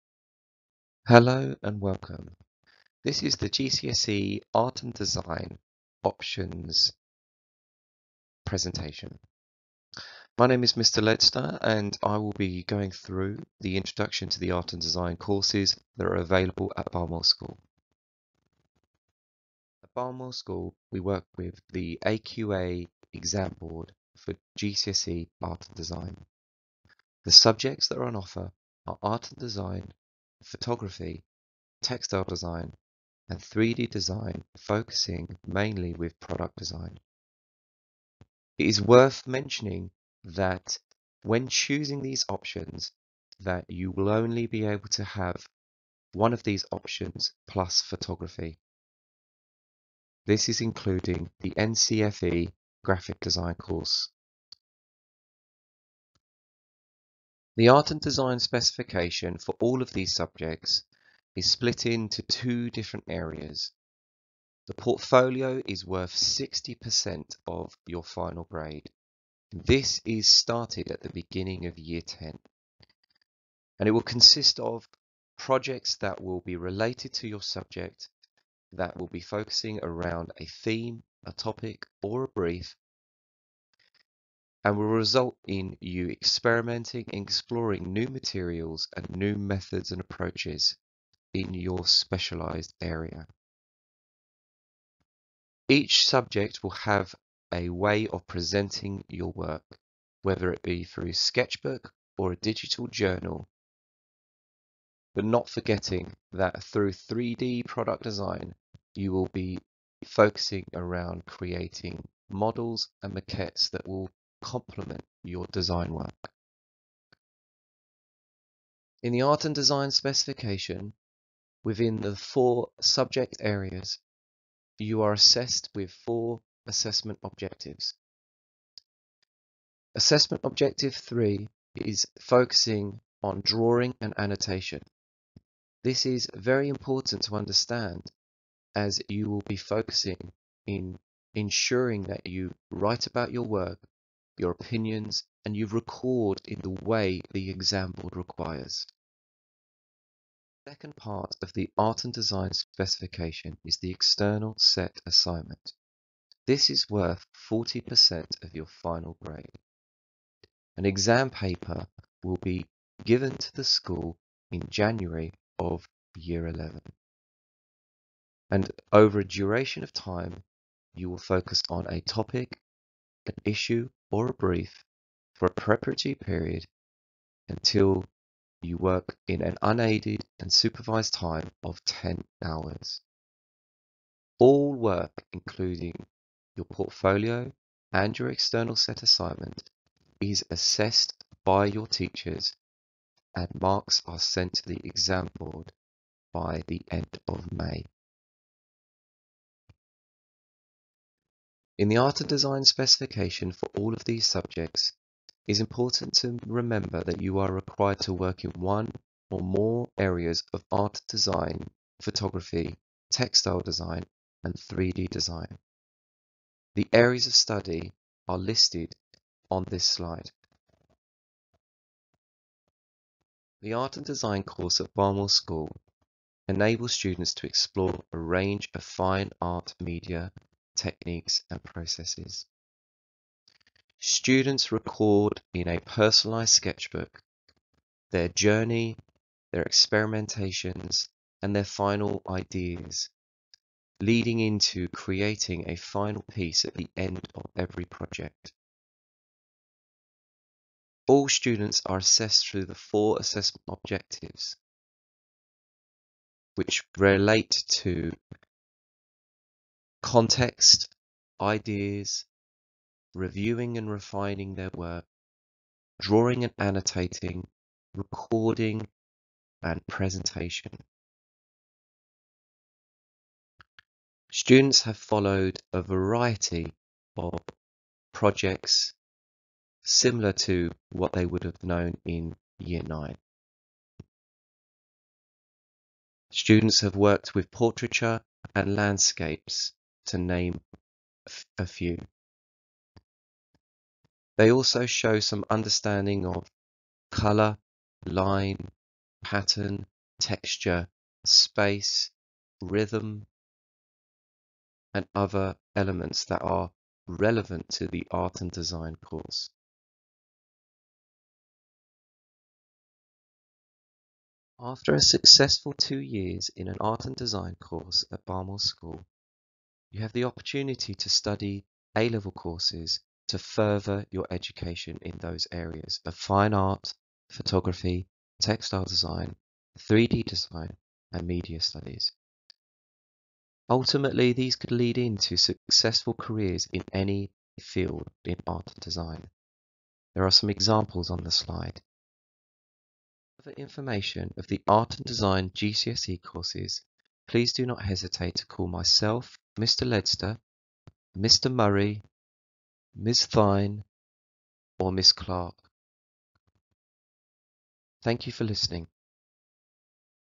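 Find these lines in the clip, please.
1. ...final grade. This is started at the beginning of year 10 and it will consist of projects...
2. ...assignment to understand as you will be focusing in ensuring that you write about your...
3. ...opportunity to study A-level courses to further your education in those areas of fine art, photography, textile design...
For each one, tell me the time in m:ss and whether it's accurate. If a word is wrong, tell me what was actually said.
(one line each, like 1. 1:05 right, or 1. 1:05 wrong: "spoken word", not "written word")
1. 1:08 right
2. 2:16 wrong: "important", not "assignment"
3. 5:20 right.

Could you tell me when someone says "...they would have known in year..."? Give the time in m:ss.
4:41.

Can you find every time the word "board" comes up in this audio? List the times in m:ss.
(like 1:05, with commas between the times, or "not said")
0:23, 2:27, 3:15.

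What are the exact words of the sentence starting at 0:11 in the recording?
Ledster and I will be going through the introduction to the Art and Design courses that are available at Barnwell School.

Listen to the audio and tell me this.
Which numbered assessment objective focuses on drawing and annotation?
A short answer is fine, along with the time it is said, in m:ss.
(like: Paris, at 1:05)
Assessment Objective 3, at 2:09.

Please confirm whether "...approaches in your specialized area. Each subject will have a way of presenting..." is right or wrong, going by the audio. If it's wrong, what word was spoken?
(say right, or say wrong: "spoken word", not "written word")
right.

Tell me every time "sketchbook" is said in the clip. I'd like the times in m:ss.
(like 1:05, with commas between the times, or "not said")
1:41, 3:56.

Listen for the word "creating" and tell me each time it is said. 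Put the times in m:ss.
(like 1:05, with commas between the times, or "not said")
1:51, 4:04.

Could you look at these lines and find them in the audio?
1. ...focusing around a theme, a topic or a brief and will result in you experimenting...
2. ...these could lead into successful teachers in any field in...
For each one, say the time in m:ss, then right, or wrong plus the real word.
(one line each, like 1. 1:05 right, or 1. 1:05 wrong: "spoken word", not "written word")
1. 1:19 right
2. 5:34 wrong: "careers", not "teachers".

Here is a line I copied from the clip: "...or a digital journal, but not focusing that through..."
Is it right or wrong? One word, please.
wrong.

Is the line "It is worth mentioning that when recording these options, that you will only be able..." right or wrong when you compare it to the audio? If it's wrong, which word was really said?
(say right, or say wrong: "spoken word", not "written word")
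wrong: "choosing", not "recording".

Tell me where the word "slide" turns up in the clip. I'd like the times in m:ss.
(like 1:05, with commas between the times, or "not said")
3:39, 5:41.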